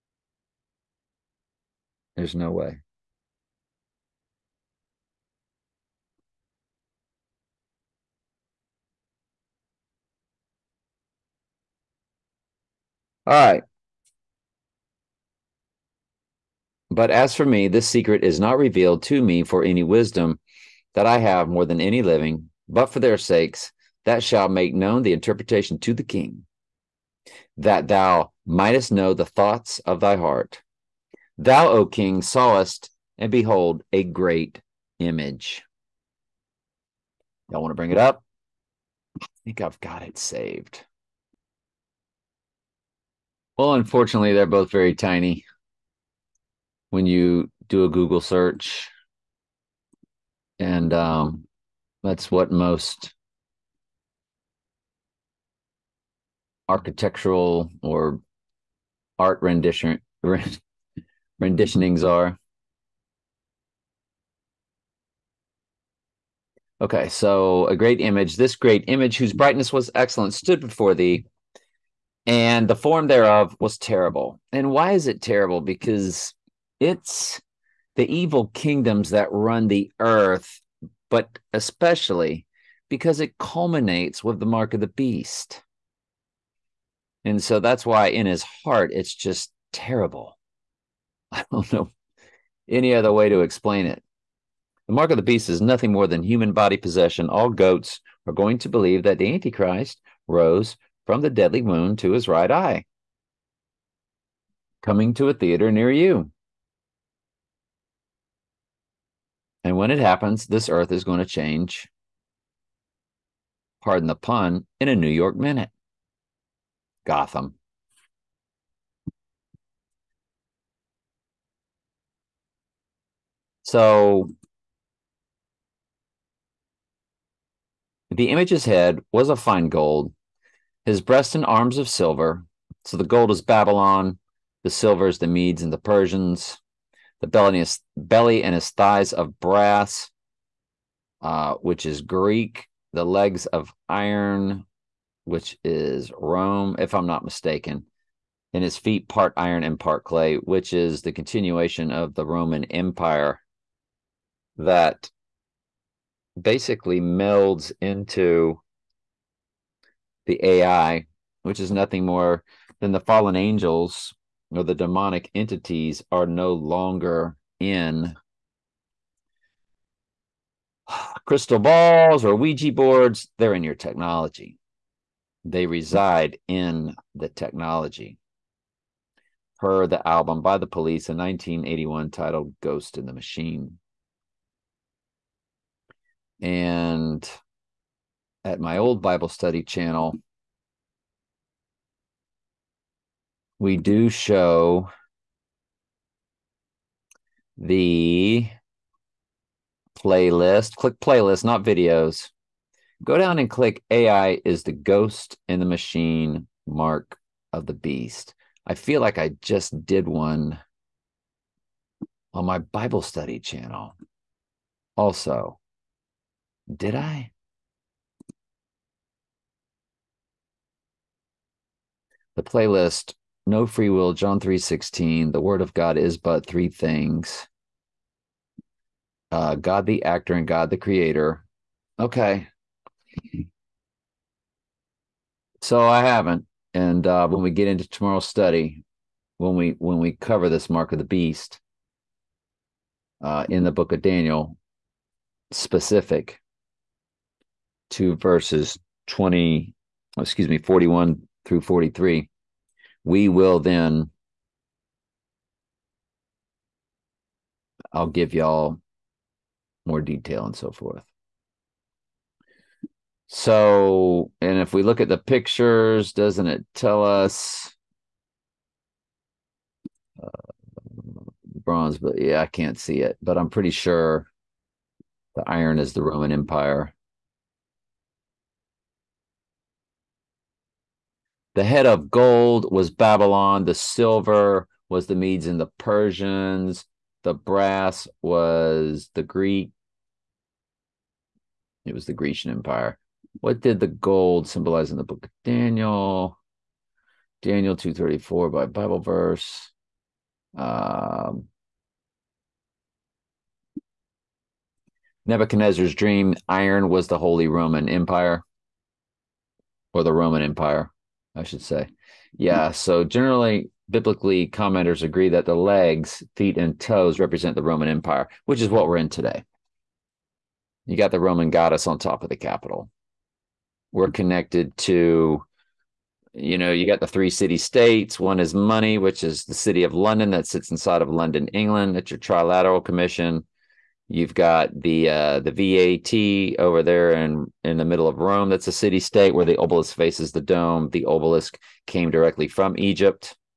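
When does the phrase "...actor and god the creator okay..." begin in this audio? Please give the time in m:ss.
3:50.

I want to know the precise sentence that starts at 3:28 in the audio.
I feel like I just did one on my Bible study channel.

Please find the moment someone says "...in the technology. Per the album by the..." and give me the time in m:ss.
2:56.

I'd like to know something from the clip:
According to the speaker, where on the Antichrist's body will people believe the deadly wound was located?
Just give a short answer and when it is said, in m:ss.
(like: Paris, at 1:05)
right eye, at 1:42.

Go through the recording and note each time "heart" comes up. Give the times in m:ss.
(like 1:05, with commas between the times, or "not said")
0:30, 1:28.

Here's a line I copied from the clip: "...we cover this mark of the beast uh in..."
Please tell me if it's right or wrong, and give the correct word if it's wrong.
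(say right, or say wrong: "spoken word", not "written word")
right.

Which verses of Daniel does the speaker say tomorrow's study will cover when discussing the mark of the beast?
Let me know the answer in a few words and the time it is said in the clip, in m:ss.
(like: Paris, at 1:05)
41 through 43, at 4:10.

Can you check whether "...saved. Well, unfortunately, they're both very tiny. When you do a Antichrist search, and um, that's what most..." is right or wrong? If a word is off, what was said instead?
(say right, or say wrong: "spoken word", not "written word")
wrong: "Google", not "Antichrist".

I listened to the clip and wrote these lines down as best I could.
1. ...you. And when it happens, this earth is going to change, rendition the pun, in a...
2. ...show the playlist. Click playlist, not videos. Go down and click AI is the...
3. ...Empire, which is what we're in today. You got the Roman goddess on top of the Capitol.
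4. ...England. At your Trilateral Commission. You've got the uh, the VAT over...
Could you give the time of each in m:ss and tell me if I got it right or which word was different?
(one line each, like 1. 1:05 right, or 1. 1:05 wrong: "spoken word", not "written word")
1. 1:45 wrong: "pardon", not "rendition"
2. 3:14 right
3. 5:17 right
4. 5:31 right.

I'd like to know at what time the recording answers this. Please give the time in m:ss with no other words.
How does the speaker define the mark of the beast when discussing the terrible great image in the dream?
1:36.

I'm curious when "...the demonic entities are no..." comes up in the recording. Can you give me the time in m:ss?
2:44.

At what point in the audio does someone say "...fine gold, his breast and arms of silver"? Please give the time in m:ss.
2:09.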